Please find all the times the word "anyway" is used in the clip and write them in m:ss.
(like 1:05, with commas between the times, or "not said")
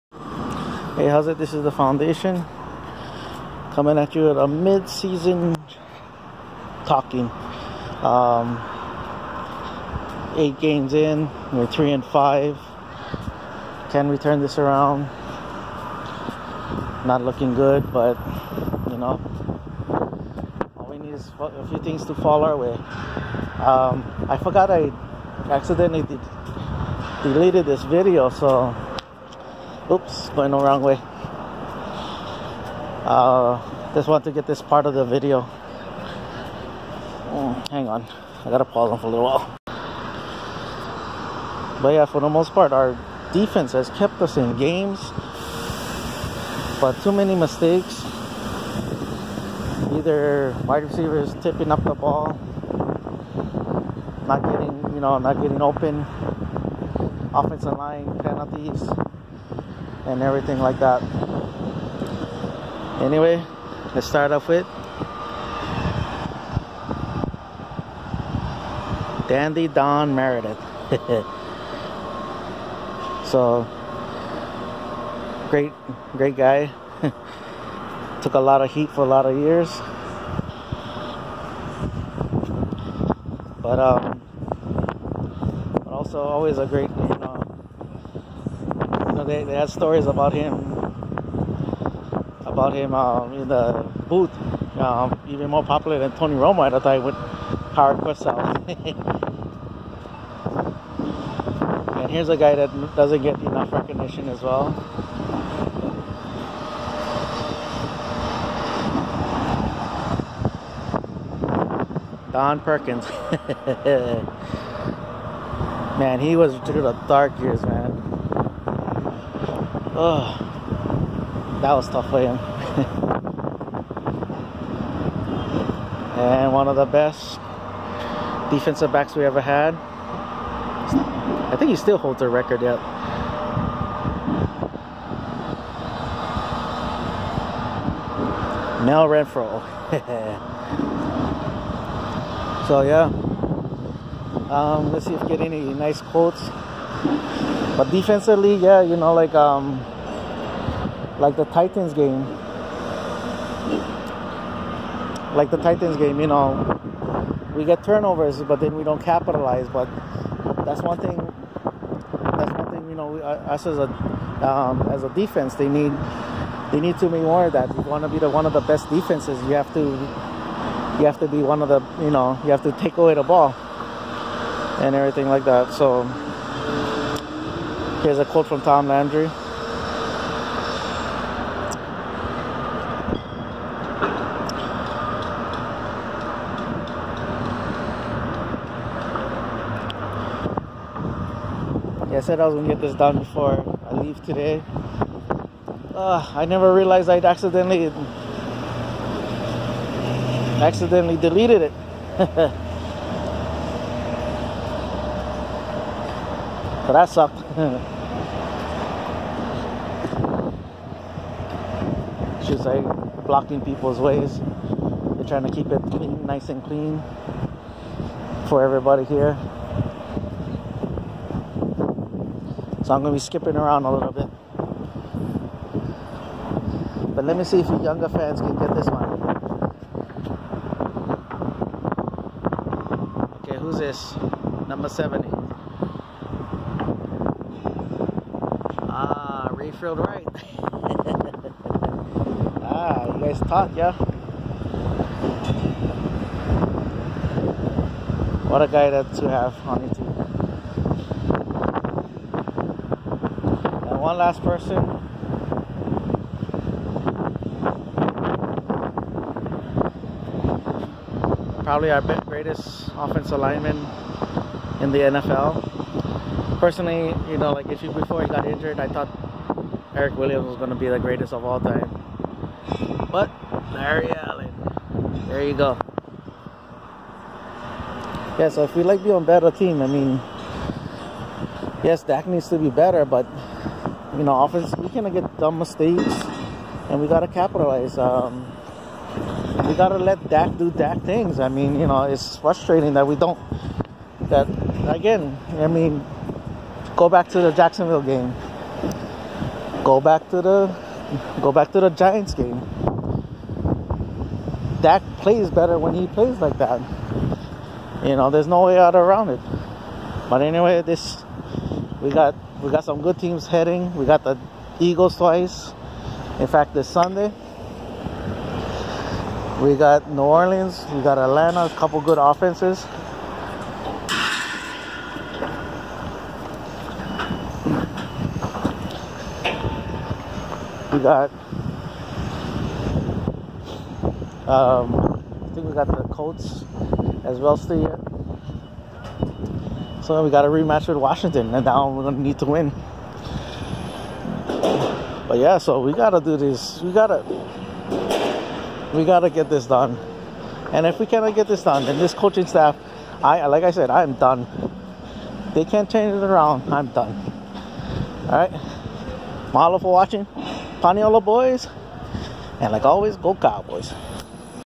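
1:03, 5:10.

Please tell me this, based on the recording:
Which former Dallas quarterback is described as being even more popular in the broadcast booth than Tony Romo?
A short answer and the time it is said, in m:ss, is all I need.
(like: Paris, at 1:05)
Don Meredith, at 1:09.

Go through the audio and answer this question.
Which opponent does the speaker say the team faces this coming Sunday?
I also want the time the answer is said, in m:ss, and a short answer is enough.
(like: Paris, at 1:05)
New Orleans, at 5:20.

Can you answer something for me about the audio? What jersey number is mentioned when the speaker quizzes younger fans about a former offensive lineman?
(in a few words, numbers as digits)
70.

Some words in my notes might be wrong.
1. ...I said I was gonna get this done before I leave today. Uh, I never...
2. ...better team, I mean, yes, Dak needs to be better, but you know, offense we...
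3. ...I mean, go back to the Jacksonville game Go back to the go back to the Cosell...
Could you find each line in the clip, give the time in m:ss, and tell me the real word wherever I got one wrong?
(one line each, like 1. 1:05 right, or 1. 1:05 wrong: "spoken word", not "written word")
1. 3:12 right
2. 4:39 right
3. 4:55 wrong: "Giants", not "Cosell".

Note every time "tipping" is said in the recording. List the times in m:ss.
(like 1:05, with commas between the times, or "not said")
0:51.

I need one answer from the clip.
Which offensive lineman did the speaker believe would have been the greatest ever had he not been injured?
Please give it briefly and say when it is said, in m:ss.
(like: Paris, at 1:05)
Erik Williams, at 4:29.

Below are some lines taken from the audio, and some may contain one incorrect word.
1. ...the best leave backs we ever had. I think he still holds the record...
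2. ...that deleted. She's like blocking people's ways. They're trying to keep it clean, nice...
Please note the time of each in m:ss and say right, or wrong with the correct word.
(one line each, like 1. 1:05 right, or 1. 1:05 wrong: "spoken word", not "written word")
1. 2:06 wrong: "defensive", not "leave"
2. 3:26 wrong: "sucked", not "deleted".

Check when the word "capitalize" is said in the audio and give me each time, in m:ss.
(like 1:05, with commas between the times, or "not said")
2:39, 4:47.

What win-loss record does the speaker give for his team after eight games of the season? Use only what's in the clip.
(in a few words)
3 and 5.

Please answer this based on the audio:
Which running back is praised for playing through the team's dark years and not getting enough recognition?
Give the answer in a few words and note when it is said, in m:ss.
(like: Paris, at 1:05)
Don Perkins, at 1:52.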